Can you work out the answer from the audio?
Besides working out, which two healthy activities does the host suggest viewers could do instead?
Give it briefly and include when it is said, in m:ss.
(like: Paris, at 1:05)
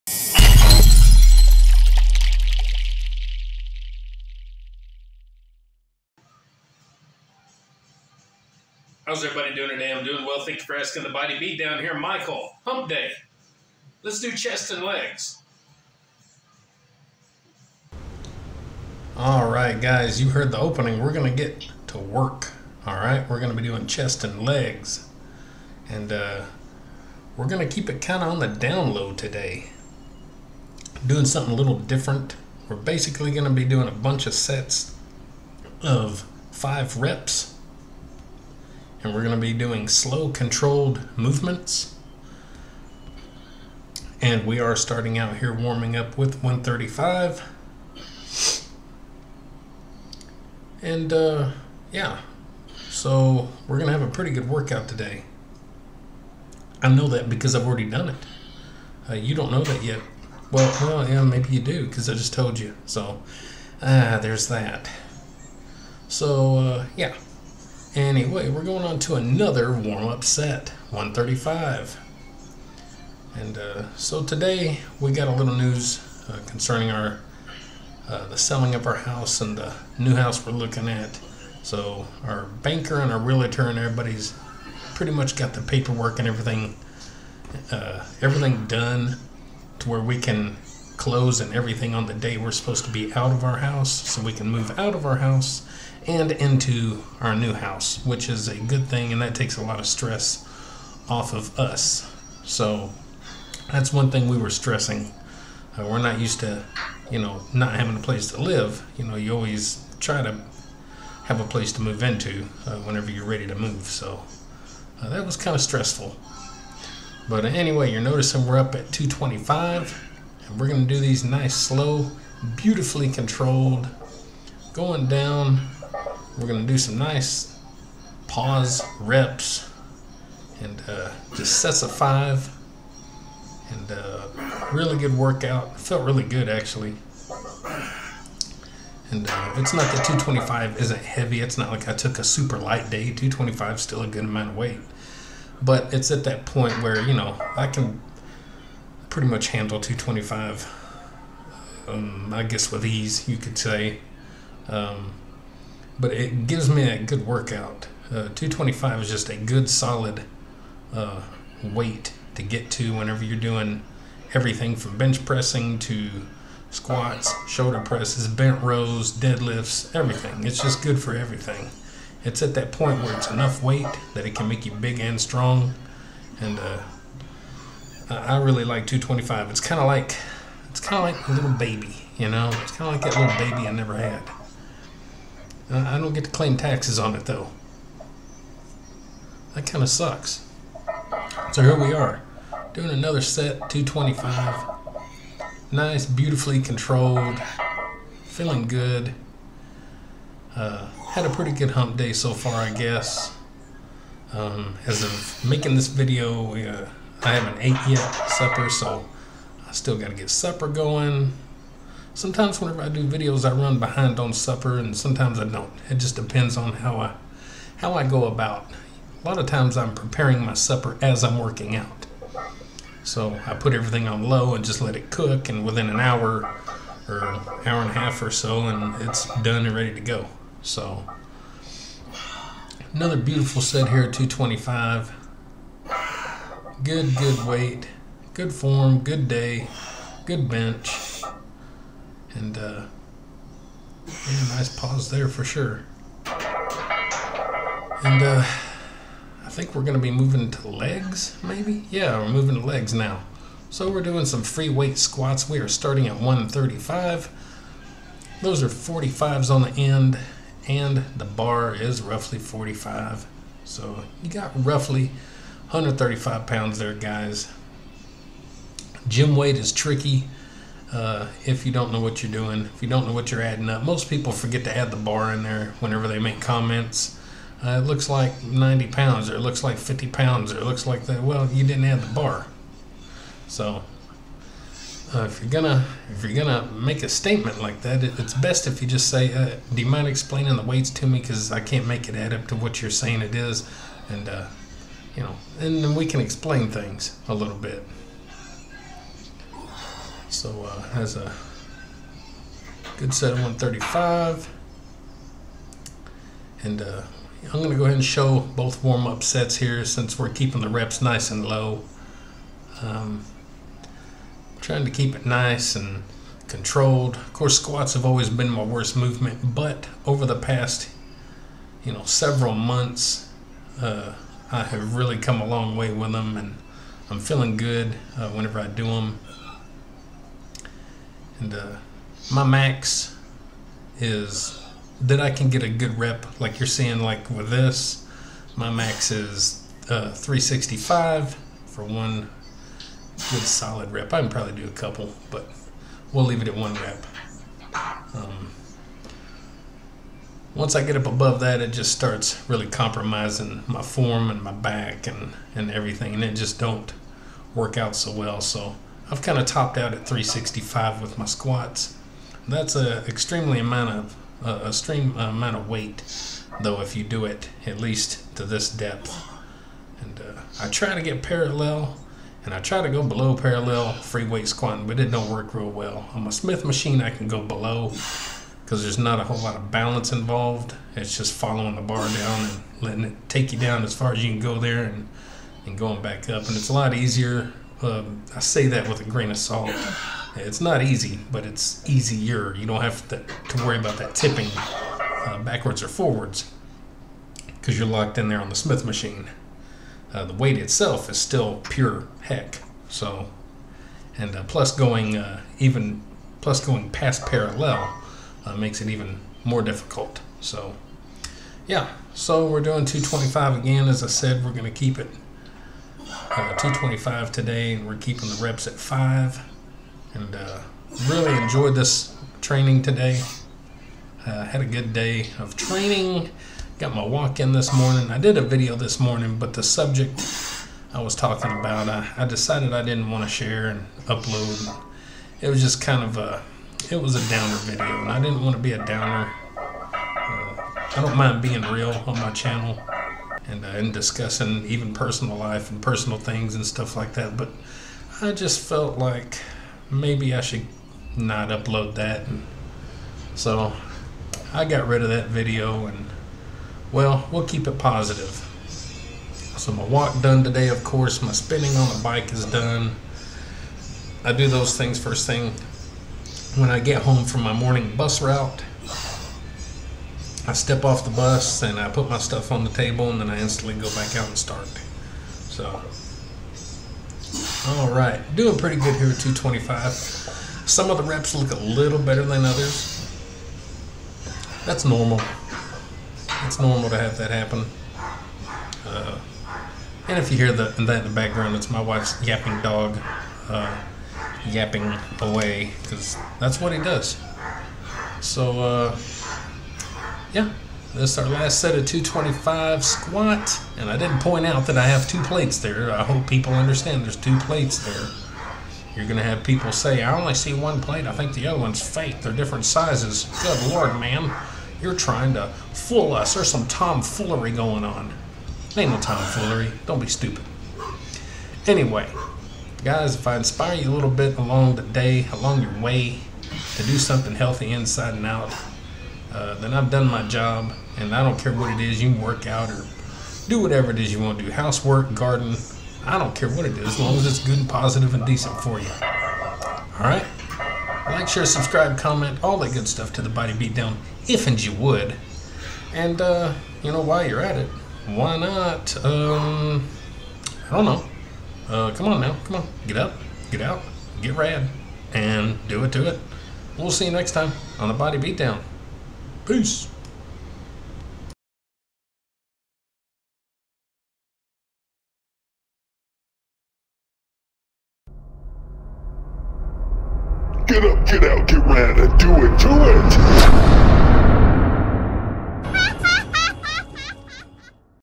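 Housework, garden, at 8:54.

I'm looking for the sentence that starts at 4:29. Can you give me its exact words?
Gym weight is tricky uh, if you don't know what you're doing, if you don't know what you're adding up.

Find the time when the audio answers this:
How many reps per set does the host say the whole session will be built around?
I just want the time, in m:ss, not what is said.
0:36.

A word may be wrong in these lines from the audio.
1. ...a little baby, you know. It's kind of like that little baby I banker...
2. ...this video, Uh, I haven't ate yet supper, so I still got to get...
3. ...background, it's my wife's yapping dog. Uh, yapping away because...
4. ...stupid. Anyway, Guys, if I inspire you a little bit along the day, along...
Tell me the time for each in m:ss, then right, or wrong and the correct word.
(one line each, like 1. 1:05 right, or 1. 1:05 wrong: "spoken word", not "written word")
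1. 3:01 wrong: "never", not "banker"
2. 3:25 right
3. 8:11 right
4. 8:40 right.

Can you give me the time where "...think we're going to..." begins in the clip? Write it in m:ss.
4:09.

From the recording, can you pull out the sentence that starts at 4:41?
Well, you didn't add the bar.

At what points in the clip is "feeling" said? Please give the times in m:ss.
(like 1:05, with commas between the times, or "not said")
3:18, 5:27.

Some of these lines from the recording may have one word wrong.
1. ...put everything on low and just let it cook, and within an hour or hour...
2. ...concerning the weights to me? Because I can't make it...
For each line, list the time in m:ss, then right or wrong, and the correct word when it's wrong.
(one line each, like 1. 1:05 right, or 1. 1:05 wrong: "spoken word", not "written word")
1. 3:43 right
2. 4:50 wrong: "explaining", not "concerning".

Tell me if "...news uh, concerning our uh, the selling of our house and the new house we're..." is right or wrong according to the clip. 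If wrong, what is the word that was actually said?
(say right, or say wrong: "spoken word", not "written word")
right.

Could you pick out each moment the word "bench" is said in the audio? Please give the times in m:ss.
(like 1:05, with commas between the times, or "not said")
2:44, 4:00.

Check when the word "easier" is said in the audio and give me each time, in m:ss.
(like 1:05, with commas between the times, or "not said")
6:26, 6:31.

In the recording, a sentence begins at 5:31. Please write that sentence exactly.
And uh, my max is that I can get a good rep, like you're seeing, like with this.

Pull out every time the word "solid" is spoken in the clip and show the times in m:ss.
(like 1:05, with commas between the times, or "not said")
2:39, 5:43.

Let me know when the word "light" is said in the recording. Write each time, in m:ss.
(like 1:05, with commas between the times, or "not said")
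2:22.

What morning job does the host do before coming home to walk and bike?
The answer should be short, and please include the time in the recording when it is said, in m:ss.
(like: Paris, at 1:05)
Bus route, at 7:47.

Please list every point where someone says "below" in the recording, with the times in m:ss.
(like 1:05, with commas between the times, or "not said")
6:13, 6:17.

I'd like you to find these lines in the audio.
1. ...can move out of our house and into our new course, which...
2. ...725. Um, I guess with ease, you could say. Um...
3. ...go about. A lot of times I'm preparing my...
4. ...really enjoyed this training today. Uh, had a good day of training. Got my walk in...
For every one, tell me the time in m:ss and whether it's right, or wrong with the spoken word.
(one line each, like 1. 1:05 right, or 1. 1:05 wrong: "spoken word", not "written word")
1. 1:34 wrong: "house", not "course"
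2. 2:29 wrong: "225", not "725"
3. 3:38 right
4. 7:01 right.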